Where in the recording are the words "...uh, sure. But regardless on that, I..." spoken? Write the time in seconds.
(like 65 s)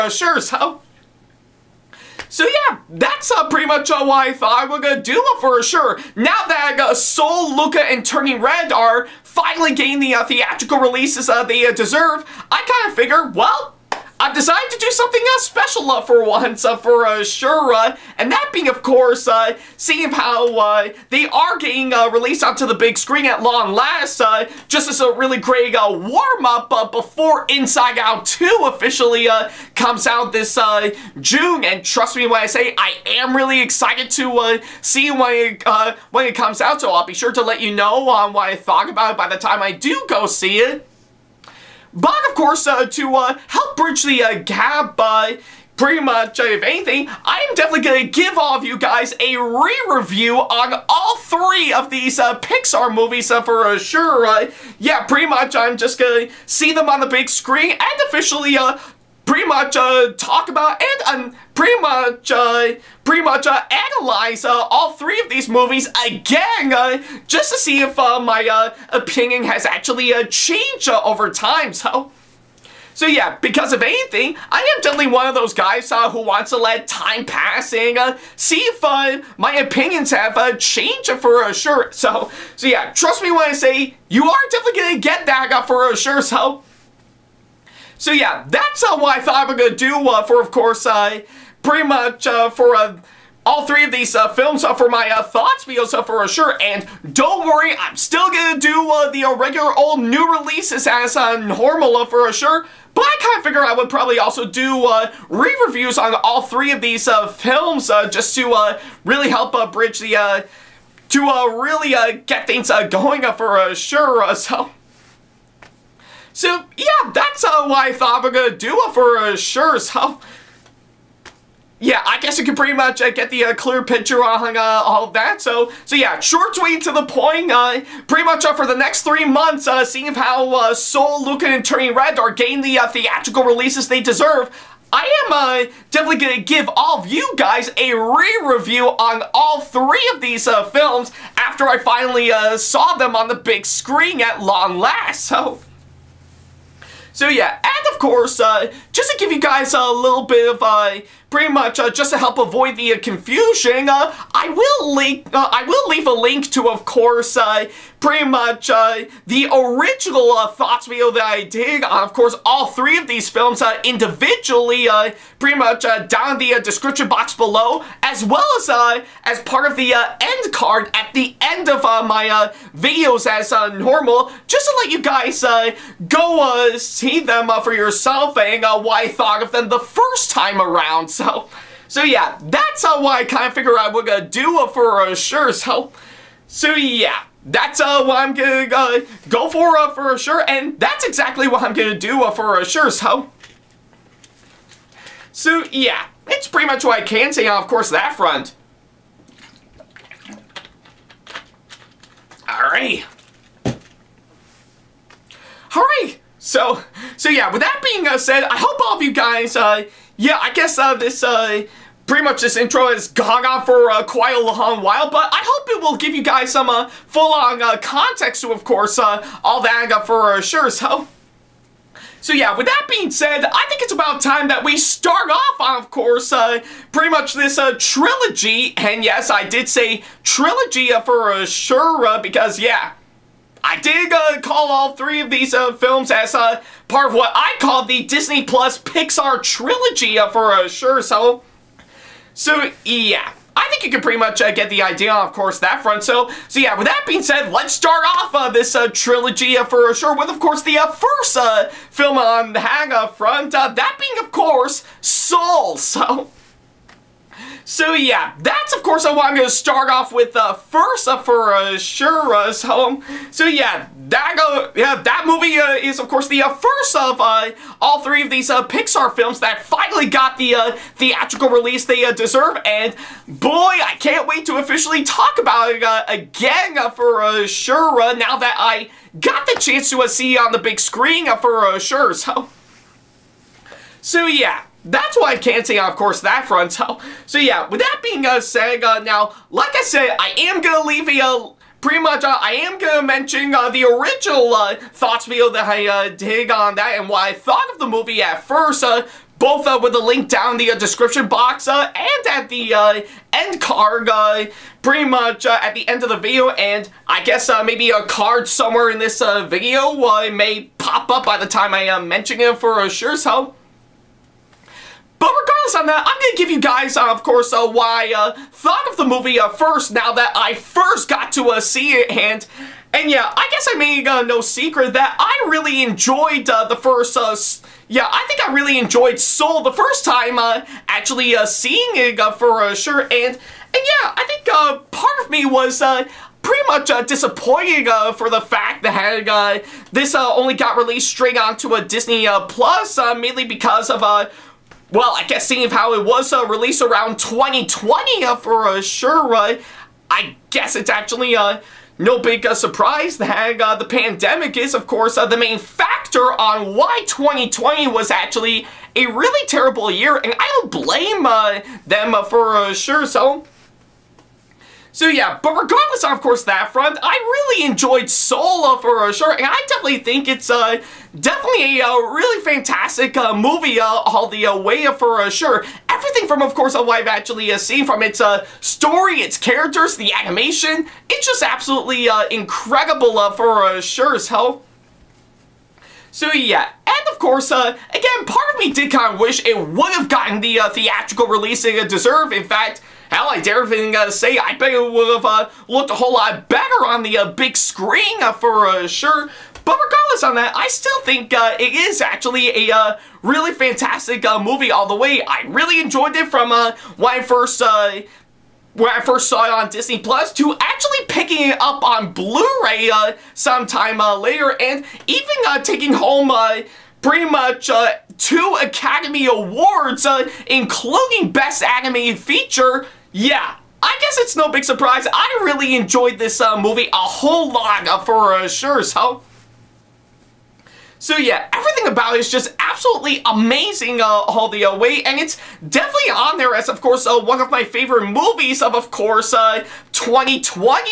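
398 s.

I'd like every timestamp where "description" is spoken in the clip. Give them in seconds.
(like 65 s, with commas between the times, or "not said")
166 s, 300 s.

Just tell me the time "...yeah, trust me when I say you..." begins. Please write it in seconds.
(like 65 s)
82 s.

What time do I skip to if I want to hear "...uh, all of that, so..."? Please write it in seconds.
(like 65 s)
124 s.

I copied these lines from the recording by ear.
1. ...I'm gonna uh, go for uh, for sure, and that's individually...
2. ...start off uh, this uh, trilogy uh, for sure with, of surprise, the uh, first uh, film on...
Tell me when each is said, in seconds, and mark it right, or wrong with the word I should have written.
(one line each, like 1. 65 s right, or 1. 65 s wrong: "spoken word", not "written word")
1. 188 s wrong: "exactly", not "individually"
2. 247 s wrong: "course", not "surprise".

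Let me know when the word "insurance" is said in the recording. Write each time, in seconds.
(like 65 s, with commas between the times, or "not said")
not said.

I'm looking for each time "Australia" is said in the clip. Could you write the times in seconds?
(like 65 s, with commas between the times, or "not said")
not said.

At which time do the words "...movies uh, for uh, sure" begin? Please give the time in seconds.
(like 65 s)
52 s.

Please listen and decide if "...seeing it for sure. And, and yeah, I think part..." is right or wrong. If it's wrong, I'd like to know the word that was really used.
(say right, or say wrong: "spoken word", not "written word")
right.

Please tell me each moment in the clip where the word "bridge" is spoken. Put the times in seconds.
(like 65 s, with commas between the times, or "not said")
43 s, 109 s.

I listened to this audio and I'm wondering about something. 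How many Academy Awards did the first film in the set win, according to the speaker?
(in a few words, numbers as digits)
2.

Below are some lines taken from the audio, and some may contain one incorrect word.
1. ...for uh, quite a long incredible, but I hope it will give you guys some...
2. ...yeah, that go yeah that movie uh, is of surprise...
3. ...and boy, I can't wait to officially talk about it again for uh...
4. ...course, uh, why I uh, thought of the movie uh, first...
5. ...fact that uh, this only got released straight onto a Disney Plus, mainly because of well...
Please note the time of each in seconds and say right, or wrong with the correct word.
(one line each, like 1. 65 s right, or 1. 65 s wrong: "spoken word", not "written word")
1. 213 s wrong: "while", not "incredible"
2. 263 s wrong: "course", not "surprise"
3. 272 s right
4. 317 s right
5. 338 s right.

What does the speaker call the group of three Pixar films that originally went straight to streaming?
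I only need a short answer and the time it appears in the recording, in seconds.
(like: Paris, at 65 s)
Disney Plus Pixar trilogy, at 238 s.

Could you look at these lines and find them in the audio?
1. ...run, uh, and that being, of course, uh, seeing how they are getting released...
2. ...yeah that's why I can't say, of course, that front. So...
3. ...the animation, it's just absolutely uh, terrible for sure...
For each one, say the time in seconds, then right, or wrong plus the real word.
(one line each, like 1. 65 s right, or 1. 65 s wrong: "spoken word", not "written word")
1. 17 s right
2. 284 s right
3. 379 s wrong: "incredible", not "terrible".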